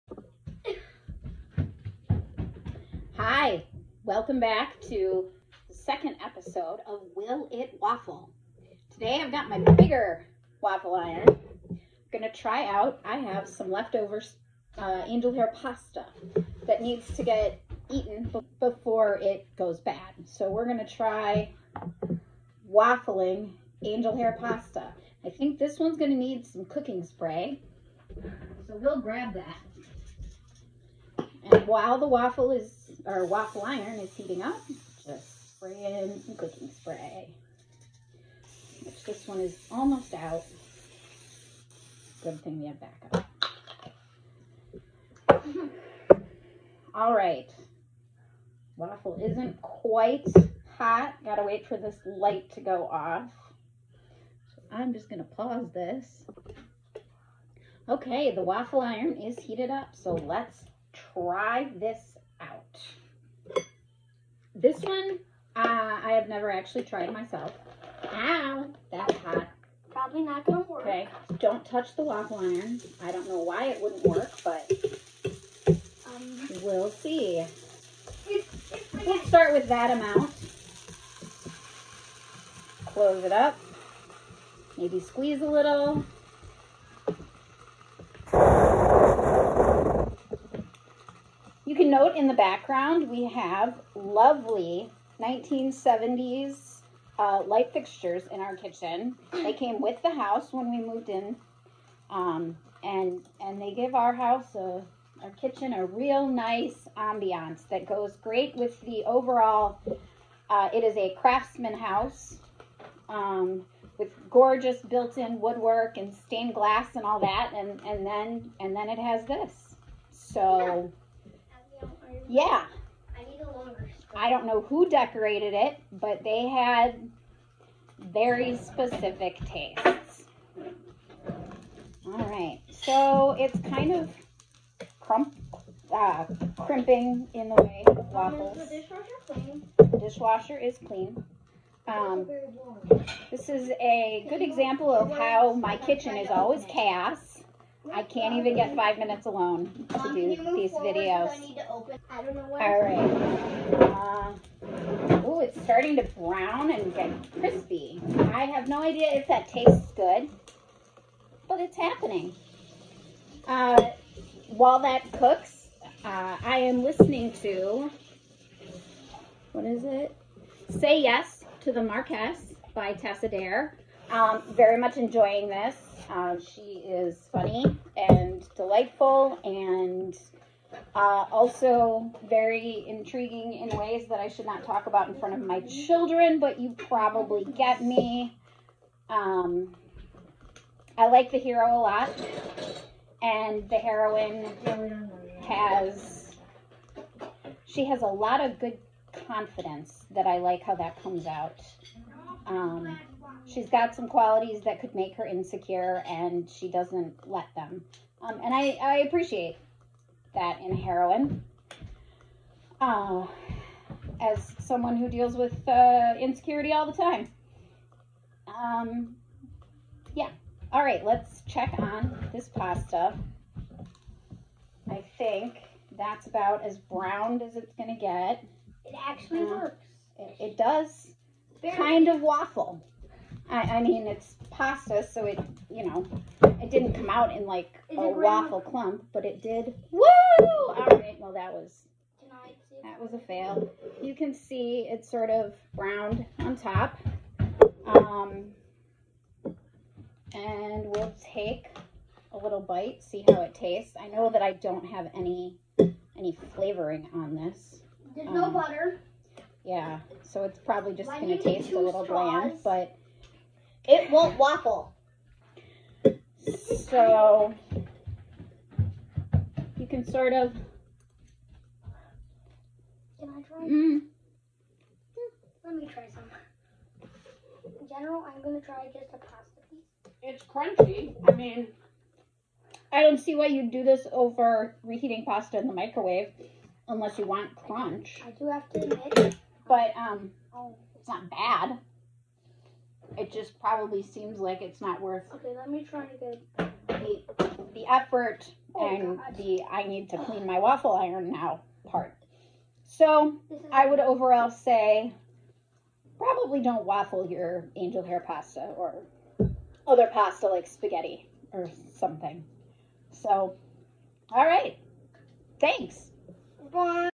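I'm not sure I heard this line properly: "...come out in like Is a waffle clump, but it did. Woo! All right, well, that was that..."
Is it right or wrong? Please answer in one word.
right.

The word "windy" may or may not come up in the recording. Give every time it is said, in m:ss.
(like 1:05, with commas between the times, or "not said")
not said.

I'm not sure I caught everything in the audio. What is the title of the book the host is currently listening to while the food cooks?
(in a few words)
Say Yes to the Marquess.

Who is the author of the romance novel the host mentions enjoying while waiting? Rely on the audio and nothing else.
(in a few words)
Tessa Dare.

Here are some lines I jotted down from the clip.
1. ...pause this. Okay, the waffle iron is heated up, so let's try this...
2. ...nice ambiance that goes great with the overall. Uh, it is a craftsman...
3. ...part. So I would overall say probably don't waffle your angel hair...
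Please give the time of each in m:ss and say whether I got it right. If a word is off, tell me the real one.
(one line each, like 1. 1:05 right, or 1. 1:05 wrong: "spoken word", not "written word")
1. 0:55 right
2. 1:46 right
3. 5:01 right.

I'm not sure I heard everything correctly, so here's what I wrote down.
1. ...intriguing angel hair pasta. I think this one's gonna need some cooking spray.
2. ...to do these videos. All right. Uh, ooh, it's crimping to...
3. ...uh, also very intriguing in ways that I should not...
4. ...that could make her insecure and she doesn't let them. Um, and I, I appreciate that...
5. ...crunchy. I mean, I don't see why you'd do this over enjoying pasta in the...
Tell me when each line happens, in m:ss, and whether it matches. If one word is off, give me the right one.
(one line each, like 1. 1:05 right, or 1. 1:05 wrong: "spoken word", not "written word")
1. 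0:22 wrong: "waffling", not "intriguing"
2. 2:29 wrong: "starting", not "crimping"
3. 3:00 right
4. 3:24 right
5. 4:40 wrong: "reheating", not "enjoying".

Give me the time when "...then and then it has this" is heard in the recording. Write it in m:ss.
1:58.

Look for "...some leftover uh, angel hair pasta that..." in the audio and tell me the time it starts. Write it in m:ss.
0:13.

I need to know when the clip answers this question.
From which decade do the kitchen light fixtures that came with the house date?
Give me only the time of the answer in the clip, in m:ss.
1:35.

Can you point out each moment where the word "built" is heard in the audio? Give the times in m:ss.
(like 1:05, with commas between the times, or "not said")
1:54.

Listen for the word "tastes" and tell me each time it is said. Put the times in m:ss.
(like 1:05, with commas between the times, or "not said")
2:09, 2:39, 4:13, 4:21.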